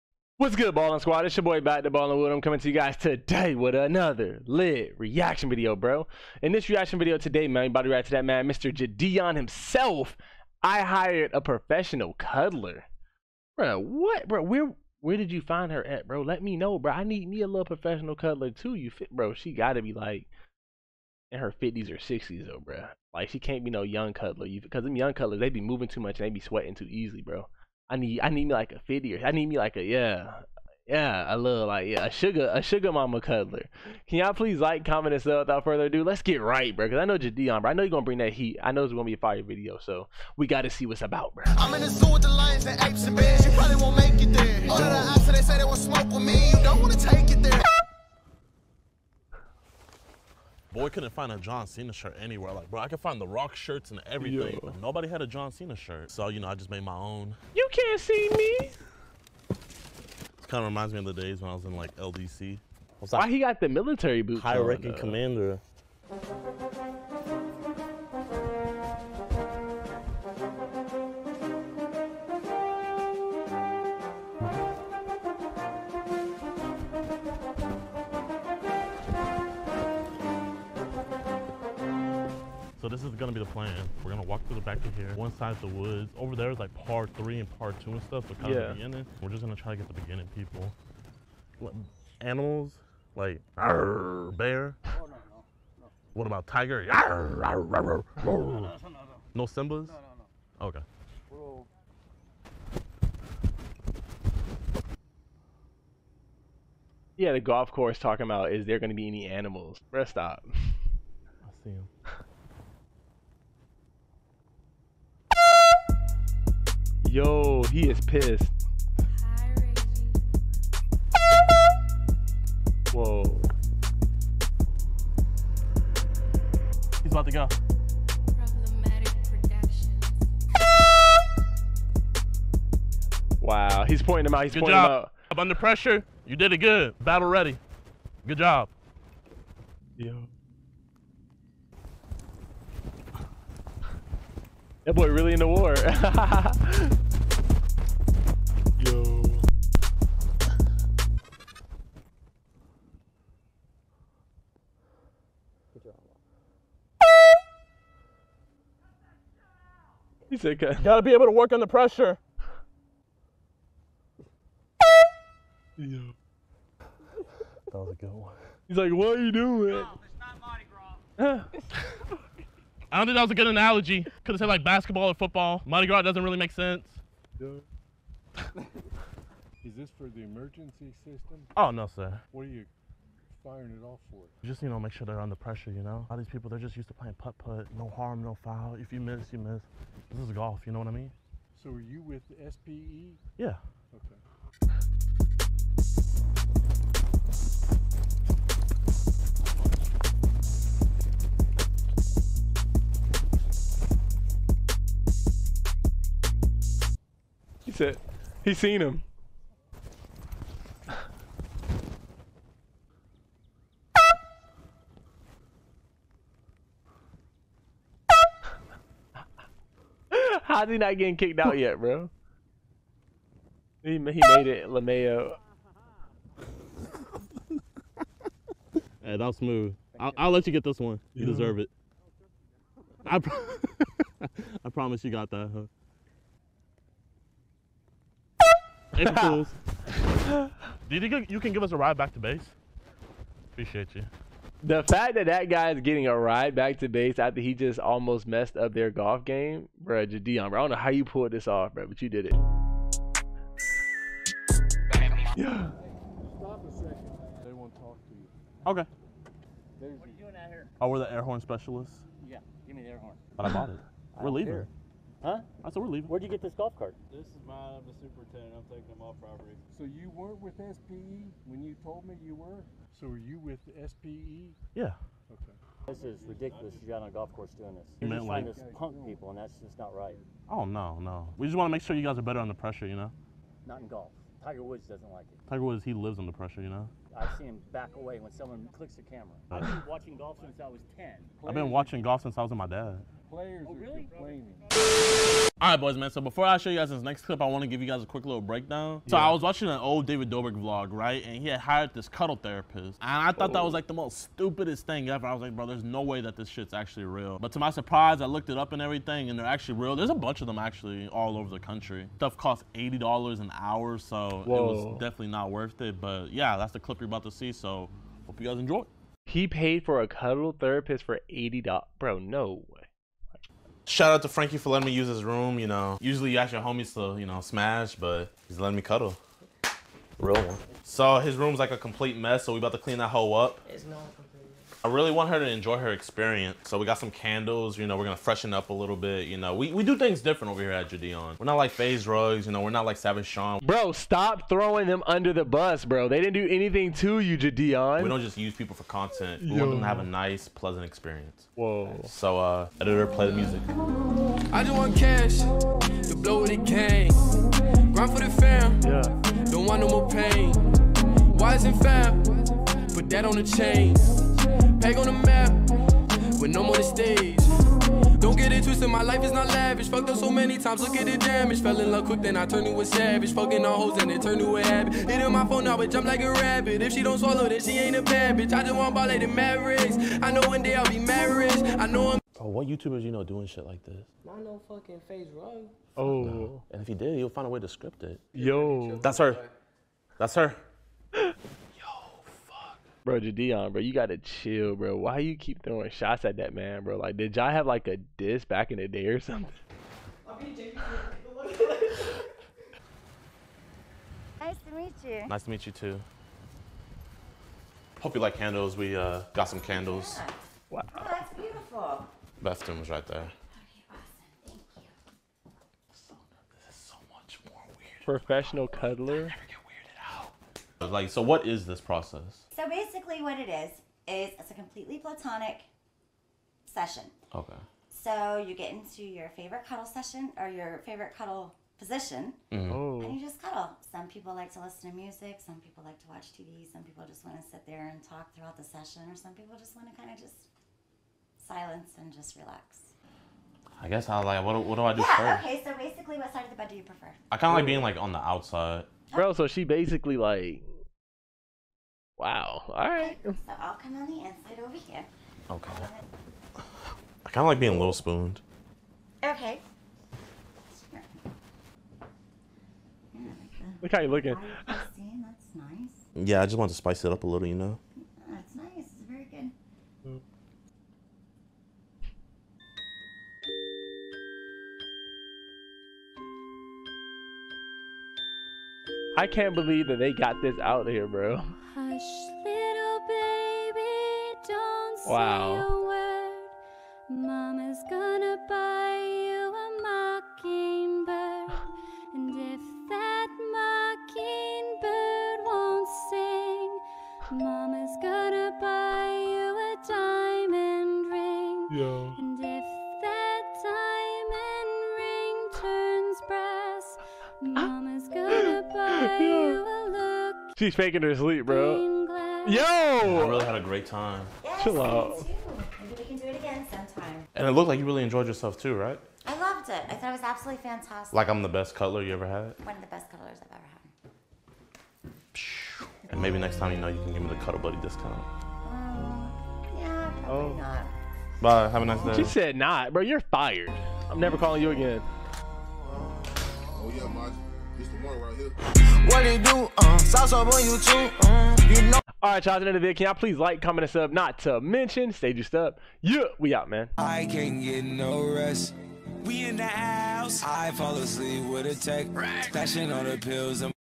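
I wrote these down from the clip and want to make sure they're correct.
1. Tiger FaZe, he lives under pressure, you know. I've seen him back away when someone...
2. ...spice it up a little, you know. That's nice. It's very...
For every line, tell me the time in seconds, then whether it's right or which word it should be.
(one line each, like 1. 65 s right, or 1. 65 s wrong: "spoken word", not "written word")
1. 285 s wrong: "Woods", not "FaZe"
2. 466 s right.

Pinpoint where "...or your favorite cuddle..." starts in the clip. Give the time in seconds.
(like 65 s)
430 s.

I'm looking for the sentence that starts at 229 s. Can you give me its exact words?
I'll, I'll, let you get this one.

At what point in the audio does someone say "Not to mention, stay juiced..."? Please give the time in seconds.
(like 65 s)
544 s.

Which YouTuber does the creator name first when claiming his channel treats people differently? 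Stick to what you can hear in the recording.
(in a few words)
FaZe Rugs.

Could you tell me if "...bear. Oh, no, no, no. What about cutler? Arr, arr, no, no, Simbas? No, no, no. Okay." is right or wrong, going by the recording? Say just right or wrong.
wrong.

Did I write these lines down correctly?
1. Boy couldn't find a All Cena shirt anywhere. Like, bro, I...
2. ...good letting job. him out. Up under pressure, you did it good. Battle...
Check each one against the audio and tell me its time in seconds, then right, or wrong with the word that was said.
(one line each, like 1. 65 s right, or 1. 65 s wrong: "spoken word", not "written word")
1. 50 s wrong: "John", not "All"
2. 134 s wrong: "pointing", not "letting".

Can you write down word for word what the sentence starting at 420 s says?
Like, so what is this process?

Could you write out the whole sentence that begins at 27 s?
I need I need me like a fifty or I need me like a yeah.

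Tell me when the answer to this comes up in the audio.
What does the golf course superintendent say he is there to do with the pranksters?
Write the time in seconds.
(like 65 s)
268 s.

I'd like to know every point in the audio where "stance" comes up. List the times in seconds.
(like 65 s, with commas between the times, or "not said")
not said.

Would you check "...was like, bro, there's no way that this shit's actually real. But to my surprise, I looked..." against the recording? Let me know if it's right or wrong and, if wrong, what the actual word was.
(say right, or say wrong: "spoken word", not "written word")
right.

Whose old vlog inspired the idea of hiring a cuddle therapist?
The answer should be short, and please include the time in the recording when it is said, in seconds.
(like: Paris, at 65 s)
David Dobrik, at 300 s.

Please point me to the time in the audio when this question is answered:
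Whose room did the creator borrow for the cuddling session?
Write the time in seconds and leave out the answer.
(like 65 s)
324 s.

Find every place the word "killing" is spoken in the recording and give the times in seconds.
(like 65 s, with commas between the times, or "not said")
not said.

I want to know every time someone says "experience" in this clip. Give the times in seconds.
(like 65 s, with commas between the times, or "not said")
335 s, 350 s.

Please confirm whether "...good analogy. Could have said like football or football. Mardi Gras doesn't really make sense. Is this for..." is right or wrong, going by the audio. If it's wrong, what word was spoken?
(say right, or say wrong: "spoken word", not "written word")
wrong: "basketball", not "football".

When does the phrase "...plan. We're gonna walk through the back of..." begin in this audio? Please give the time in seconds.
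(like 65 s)
83 s.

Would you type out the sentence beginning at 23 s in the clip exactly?
Like, she can't be no young cuddler.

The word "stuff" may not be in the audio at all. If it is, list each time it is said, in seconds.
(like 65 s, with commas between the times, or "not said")
88 s, 312 s.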